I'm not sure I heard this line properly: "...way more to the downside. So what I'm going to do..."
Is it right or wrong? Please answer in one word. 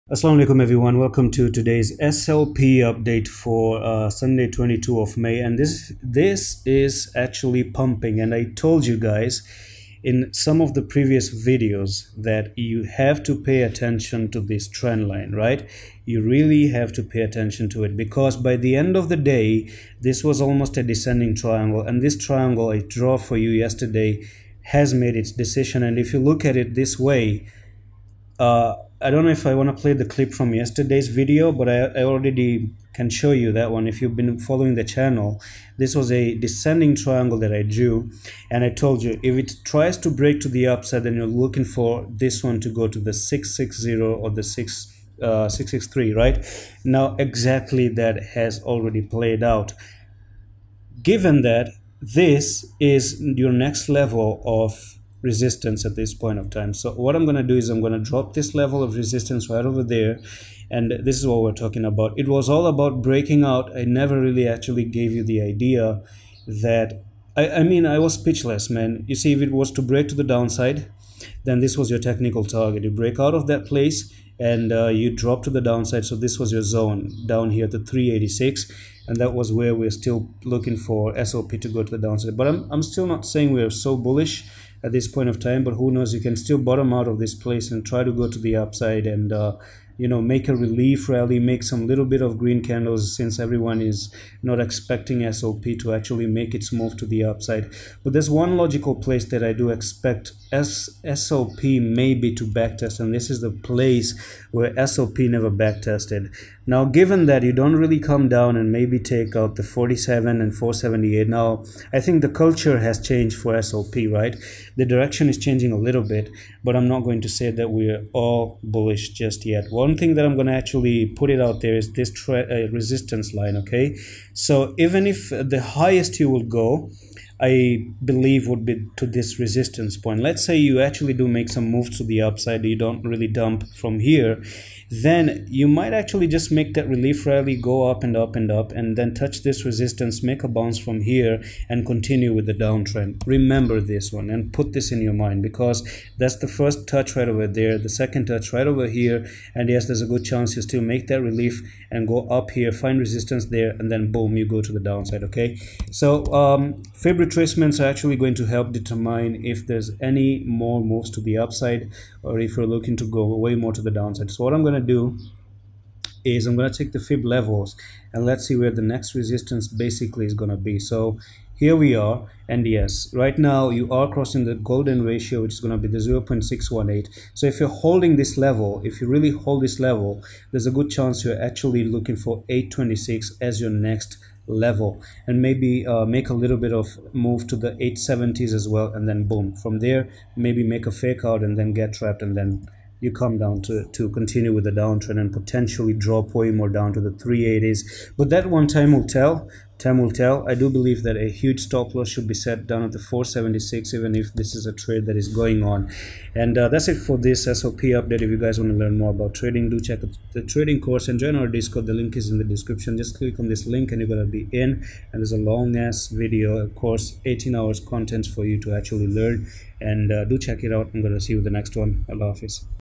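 right.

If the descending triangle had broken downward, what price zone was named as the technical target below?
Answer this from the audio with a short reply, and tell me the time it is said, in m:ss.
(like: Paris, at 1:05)
386, at 1:17.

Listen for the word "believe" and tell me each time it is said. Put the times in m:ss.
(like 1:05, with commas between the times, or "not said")
2:08, 3:20.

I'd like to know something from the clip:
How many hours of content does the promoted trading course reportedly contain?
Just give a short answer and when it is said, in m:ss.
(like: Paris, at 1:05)
18 hours, at 3:37.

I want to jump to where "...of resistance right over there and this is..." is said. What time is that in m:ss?
0:58.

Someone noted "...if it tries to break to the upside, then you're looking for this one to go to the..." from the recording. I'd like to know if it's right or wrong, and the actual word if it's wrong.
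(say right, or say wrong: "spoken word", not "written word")
right.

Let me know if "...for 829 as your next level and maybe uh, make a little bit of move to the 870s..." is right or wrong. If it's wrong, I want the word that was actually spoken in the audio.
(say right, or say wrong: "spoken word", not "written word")
wrong: "826", not "829".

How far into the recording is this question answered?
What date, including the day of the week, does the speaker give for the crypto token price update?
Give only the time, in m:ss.
0:04.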